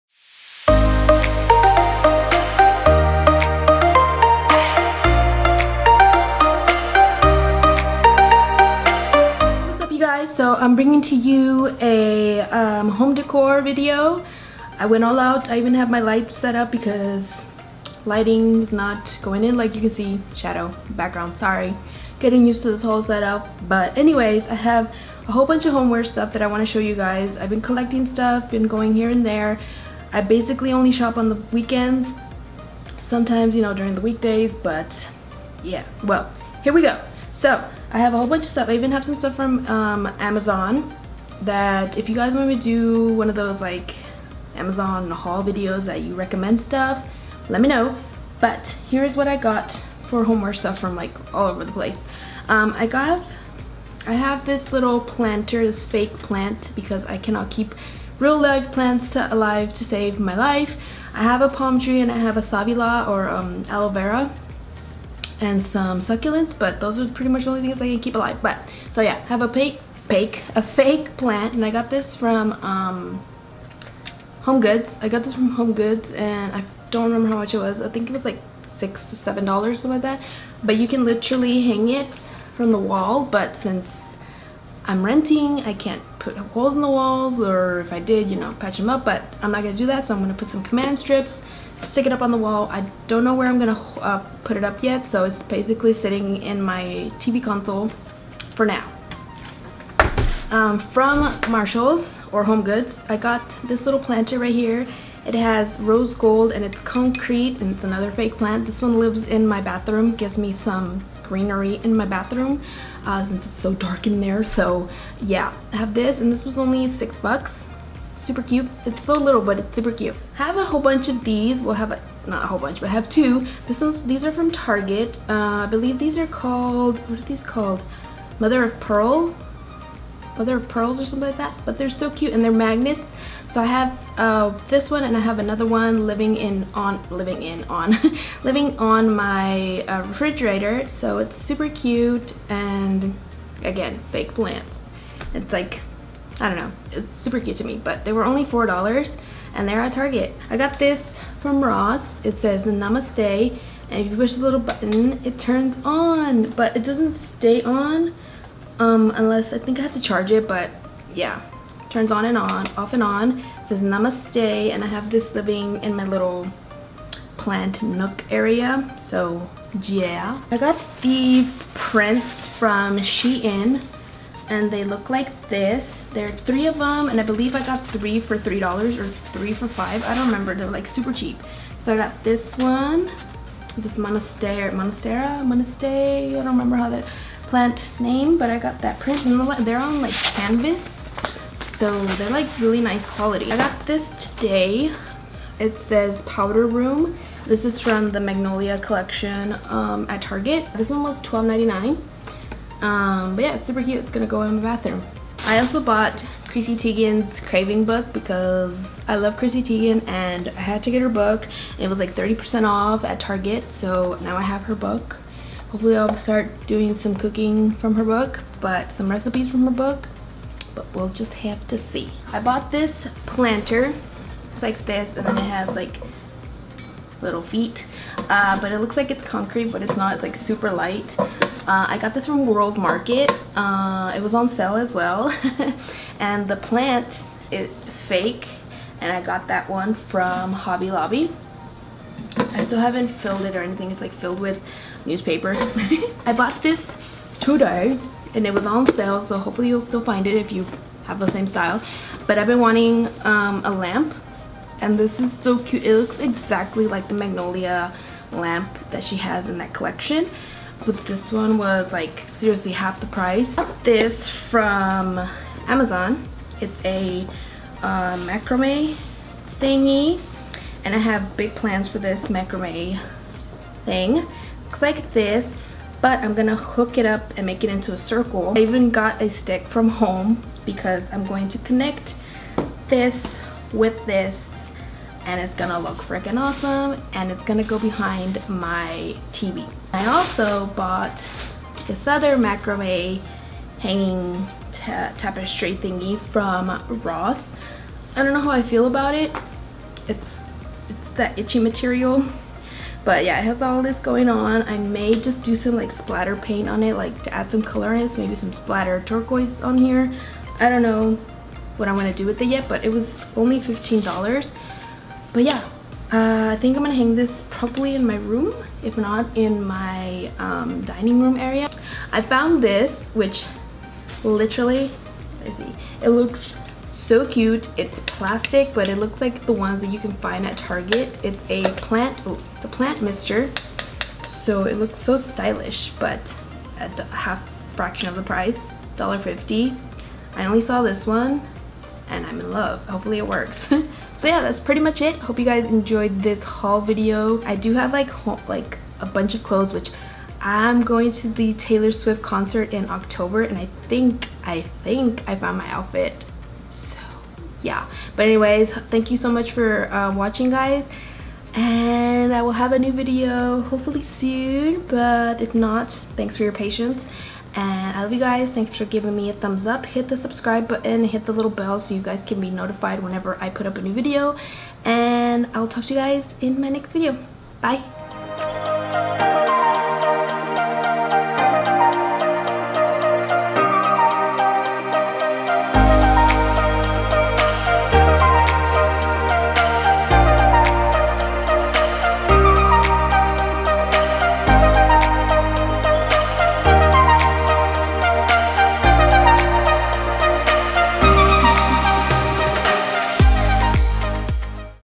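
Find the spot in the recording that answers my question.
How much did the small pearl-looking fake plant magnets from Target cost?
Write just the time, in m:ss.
2:28.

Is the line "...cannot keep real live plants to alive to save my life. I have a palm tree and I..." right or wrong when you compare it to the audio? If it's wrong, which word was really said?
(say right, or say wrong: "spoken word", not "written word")
right.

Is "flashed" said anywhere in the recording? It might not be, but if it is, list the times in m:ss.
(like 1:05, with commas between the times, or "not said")
not said.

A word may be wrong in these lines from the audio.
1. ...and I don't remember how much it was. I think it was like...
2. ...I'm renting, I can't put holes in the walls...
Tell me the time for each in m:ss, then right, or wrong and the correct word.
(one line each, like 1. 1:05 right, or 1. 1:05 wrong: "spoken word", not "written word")
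1. 1:16 right
2. 1:24 right.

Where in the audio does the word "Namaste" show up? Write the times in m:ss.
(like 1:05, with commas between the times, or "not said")
2:32, 2:43.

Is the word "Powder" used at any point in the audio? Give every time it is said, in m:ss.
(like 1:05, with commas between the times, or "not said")
3:16.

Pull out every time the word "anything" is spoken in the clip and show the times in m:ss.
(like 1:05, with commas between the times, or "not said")
4:03.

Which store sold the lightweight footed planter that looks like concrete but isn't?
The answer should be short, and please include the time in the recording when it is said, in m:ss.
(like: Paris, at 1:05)
World Market, at 3:52.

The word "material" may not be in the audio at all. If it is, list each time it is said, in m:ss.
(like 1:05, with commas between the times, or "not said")
5:01.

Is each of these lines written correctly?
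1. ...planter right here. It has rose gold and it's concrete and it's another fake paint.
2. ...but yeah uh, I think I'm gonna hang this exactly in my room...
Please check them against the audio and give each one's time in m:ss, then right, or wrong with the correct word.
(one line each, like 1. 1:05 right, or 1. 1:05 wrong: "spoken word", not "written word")
1. 1:43 wrong: "plant", not "paint"
2. 5:15 wrong: "probably", not "exactly".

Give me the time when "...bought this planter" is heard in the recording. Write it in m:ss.
3:42.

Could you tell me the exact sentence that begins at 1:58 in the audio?
It's so little, but it's super cute.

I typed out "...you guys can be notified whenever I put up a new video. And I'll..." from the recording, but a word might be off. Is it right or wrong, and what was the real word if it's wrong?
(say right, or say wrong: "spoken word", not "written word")
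right.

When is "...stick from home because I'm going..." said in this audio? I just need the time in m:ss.
4:39.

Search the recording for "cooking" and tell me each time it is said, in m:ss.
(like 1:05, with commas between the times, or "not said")
3:37.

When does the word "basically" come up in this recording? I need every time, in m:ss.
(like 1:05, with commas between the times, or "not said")
0:30, 1:35.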